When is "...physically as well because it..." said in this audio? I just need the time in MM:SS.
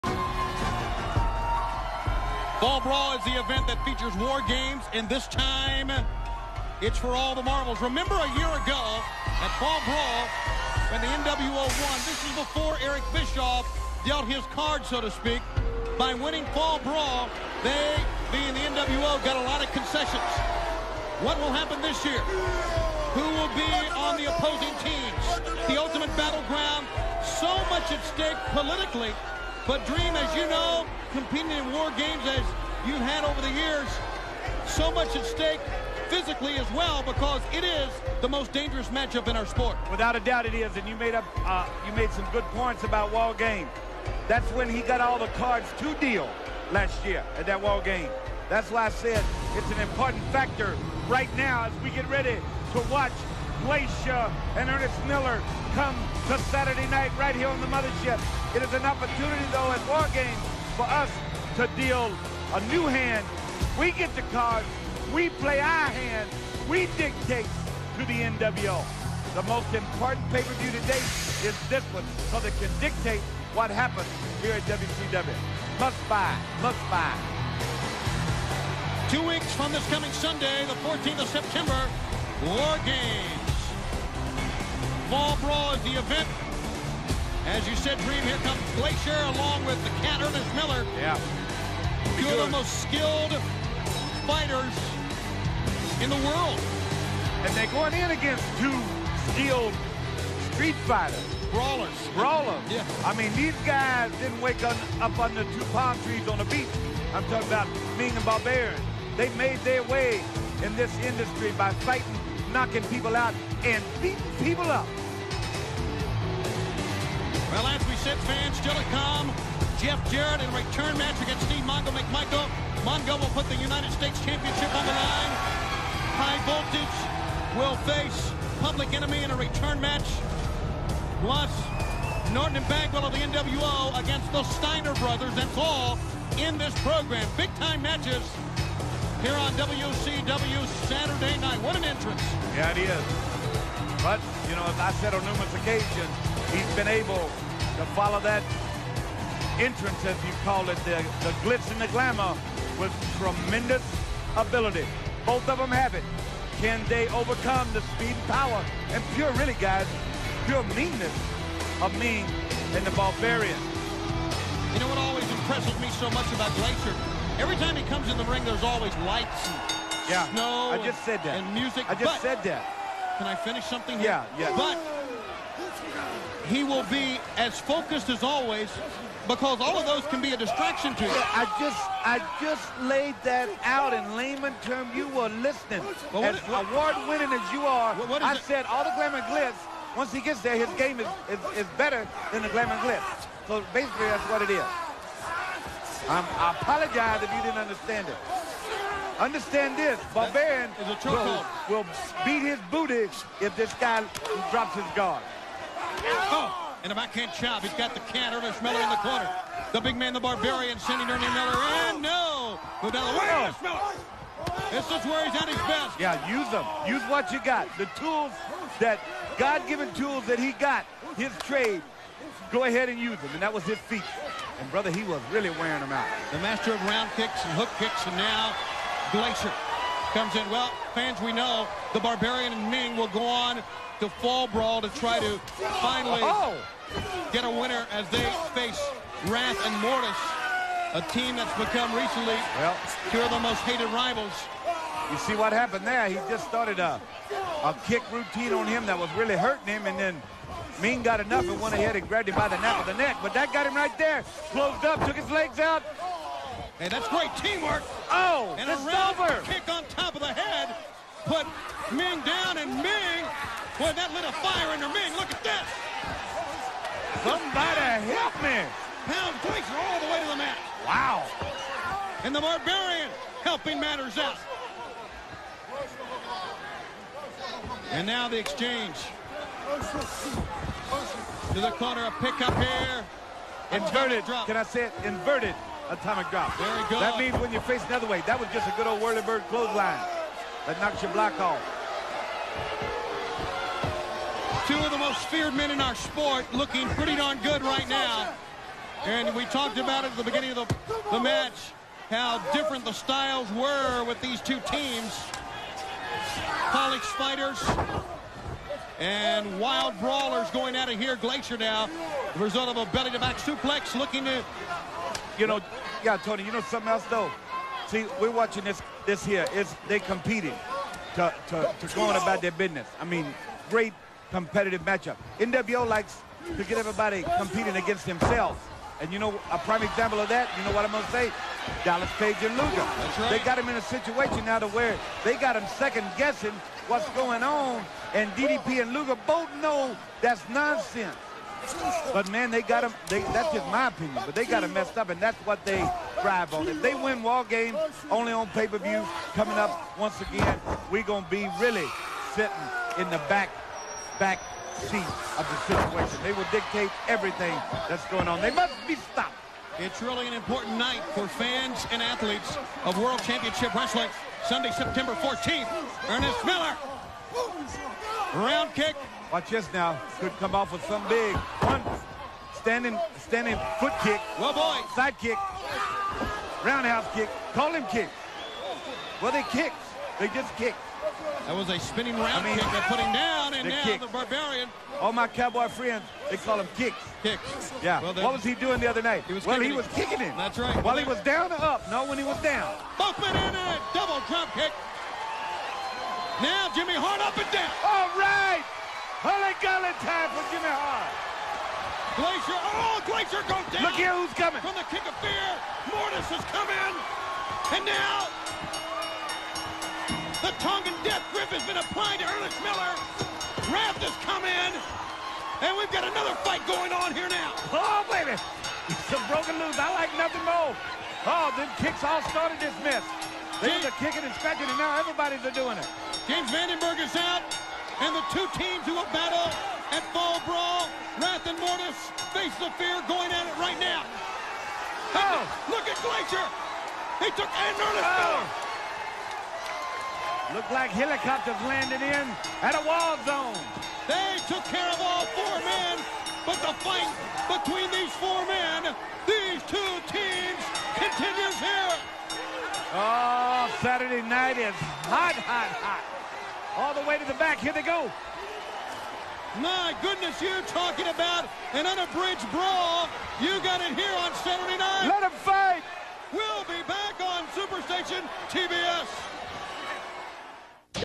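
00:36.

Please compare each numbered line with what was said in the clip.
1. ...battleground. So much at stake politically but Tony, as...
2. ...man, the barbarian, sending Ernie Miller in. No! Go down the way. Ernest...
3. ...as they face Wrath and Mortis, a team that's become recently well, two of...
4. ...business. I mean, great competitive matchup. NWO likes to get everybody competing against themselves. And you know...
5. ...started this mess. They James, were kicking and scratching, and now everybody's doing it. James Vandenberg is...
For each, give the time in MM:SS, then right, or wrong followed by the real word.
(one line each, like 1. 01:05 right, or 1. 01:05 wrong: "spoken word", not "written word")
1. 00:26 wrong: "Dream", not "Tony"
2. 03:29 right
3. 03:57 right
4. 05:22 right
5. 07:02 right.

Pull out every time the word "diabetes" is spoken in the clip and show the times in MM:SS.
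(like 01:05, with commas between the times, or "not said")
not said.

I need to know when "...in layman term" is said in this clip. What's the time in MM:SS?
03:03.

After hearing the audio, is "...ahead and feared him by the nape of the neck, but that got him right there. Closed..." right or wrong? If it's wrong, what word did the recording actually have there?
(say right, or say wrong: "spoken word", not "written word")
wrong: "grabbed", not "feared".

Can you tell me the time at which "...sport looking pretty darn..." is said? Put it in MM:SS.
04:55.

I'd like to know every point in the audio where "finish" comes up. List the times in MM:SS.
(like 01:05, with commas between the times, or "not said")
02:53.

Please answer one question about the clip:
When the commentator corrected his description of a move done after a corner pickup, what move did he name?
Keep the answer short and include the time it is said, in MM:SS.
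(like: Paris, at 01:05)
Inverted atomic drop, at 04:45.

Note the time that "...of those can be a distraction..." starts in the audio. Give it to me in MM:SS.
02:59.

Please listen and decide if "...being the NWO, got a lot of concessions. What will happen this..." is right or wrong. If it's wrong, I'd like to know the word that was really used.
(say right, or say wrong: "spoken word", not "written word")
right.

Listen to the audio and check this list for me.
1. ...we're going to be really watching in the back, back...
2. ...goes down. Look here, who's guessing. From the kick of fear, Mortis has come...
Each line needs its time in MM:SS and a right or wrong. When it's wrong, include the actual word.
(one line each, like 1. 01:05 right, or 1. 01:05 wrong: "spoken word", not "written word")
1. 05:50 wrong: "sitting", not "watching"
2. 06:43 wrong: "coming", not "guessing".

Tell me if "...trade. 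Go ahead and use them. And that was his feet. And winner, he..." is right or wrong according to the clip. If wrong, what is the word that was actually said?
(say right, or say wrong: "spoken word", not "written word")
wrong: "brother", not "winner".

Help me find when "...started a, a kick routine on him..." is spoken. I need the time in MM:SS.
04:06.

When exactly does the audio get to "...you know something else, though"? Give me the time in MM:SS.
05:16.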